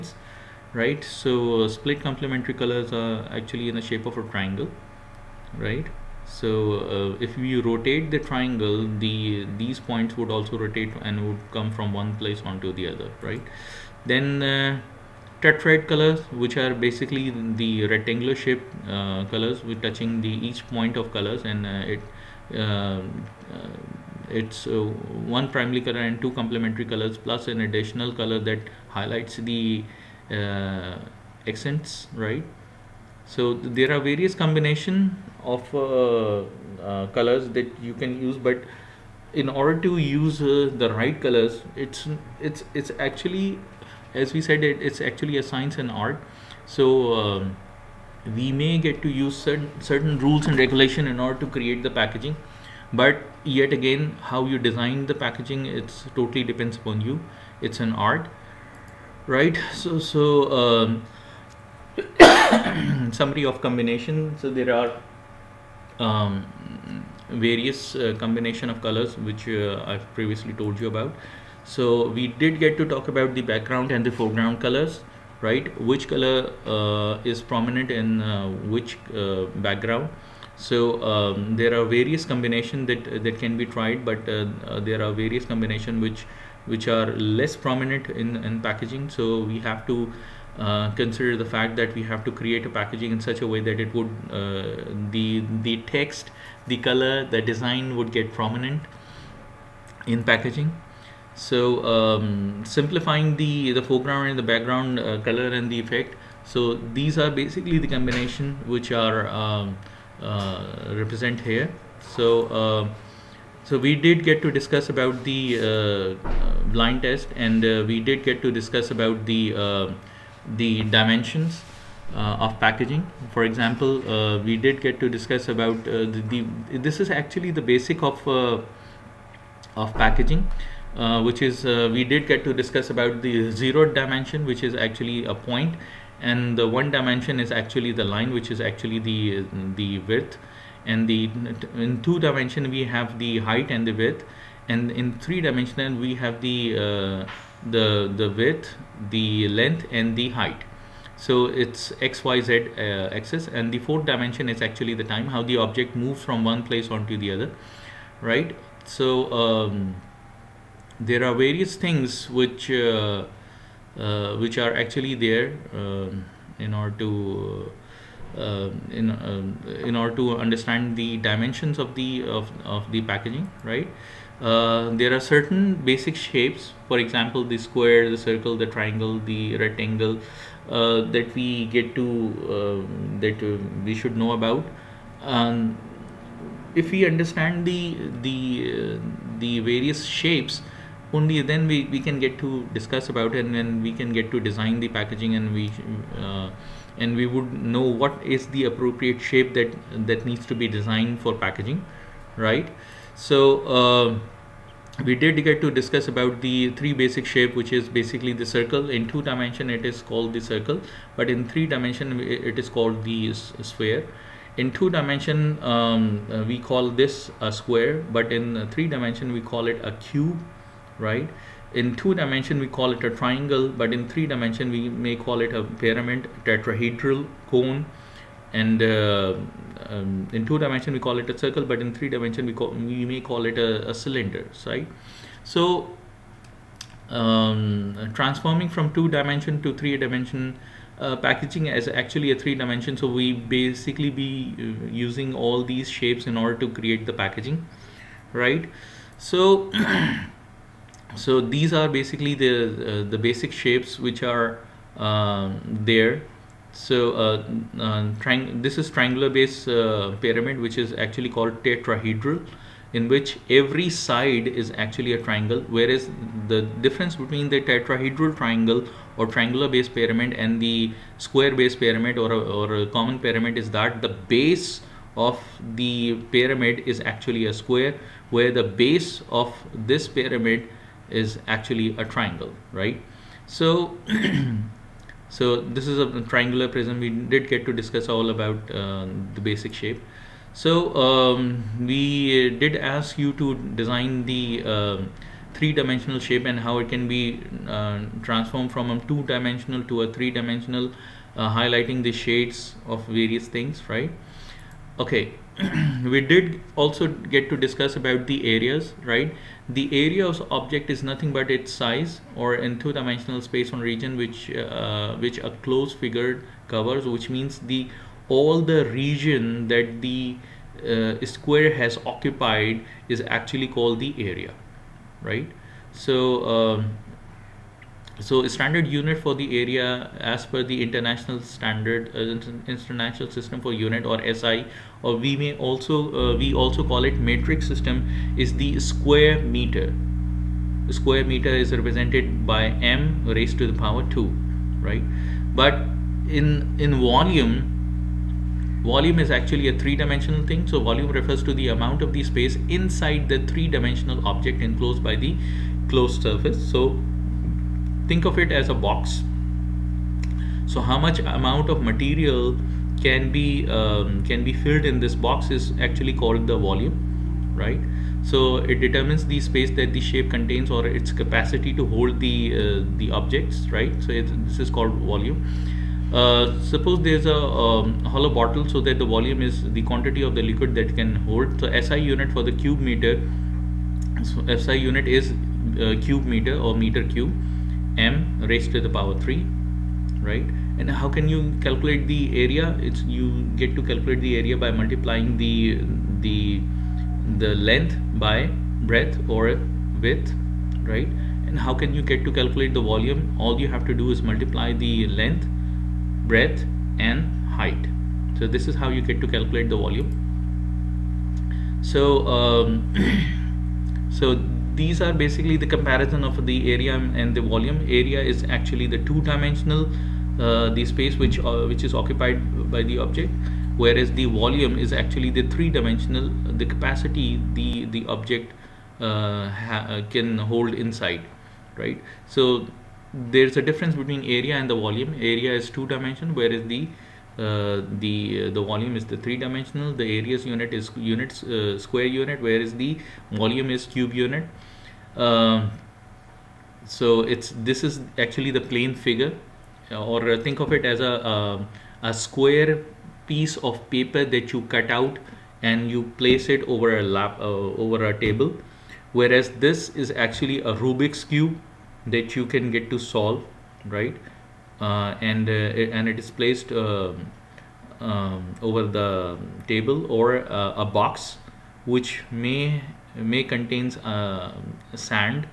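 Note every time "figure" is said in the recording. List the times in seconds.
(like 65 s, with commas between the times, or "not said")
315 s, 448 s.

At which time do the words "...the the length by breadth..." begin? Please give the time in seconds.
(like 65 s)
396 s.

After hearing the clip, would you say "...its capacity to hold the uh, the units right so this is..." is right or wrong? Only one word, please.
wrong.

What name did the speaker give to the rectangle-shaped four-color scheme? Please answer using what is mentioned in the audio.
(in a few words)
tetrad colors.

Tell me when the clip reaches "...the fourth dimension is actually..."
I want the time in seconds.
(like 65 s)
153 s.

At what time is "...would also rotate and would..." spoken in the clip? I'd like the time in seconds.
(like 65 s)
10 s.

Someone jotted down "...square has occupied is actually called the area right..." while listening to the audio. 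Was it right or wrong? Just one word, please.
right.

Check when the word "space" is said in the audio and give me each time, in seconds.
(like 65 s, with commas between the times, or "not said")
313 s, 352 s, 369 s, 420 s.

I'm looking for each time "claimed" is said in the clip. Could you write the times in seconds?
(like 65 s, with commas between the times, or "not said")
not said.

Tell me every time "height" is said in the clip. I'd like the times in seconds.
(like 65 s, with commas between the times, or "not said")
143 s, 150 s, 407 s.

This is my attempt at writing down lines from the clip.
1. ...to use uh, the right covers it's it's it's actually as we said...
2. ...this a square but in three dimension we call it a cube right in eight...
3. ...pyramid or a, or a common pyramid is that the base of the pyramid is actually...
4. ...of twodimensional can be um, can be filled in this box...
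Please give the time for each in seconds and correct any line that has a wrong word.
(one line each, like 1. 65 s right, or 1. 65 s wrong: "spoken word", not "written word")
1. 39 s wrong: "colors", not "covers"
2. 216 s wrong: "two", not "eight"
3. 271 s right
4. 361 s wrong: "material", not "twodimensional".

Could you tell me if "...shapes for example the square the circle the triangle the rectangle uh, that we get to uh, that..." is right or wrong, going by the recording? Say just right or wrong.
right.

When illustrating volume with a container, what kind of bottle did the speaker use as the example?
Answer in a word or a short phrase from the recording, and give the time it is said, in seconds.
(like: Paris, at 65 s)
hollow bottle, at 378 s.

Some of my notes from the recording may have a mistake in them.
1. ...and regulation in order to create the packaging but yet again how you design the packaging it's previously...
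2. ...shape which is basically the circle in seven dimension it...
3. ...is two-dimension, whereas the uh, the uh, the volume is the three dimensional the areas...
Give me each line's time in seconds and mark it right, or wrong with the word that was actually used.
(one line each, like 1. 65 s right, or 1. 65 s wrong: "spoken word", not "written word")
1. 50 s wrong: "totally", not "previously"
2. 207 s wrong: "two", not "seven"
3. 435 s right.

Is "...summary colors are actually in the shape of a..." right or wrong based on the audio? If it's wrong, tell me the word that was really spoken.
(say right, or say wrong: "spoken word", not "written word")
wrong: "complementary", not "summary".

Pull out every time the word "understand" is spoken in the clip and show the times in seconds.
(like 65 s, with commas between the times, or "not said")
170 s, 187 s.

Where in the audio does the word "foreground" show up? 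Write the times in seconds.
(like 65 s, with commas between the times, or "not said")
74 s, 103 s.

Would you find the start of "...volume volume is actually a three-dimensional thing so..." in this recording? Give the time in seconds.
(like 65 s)
347 s.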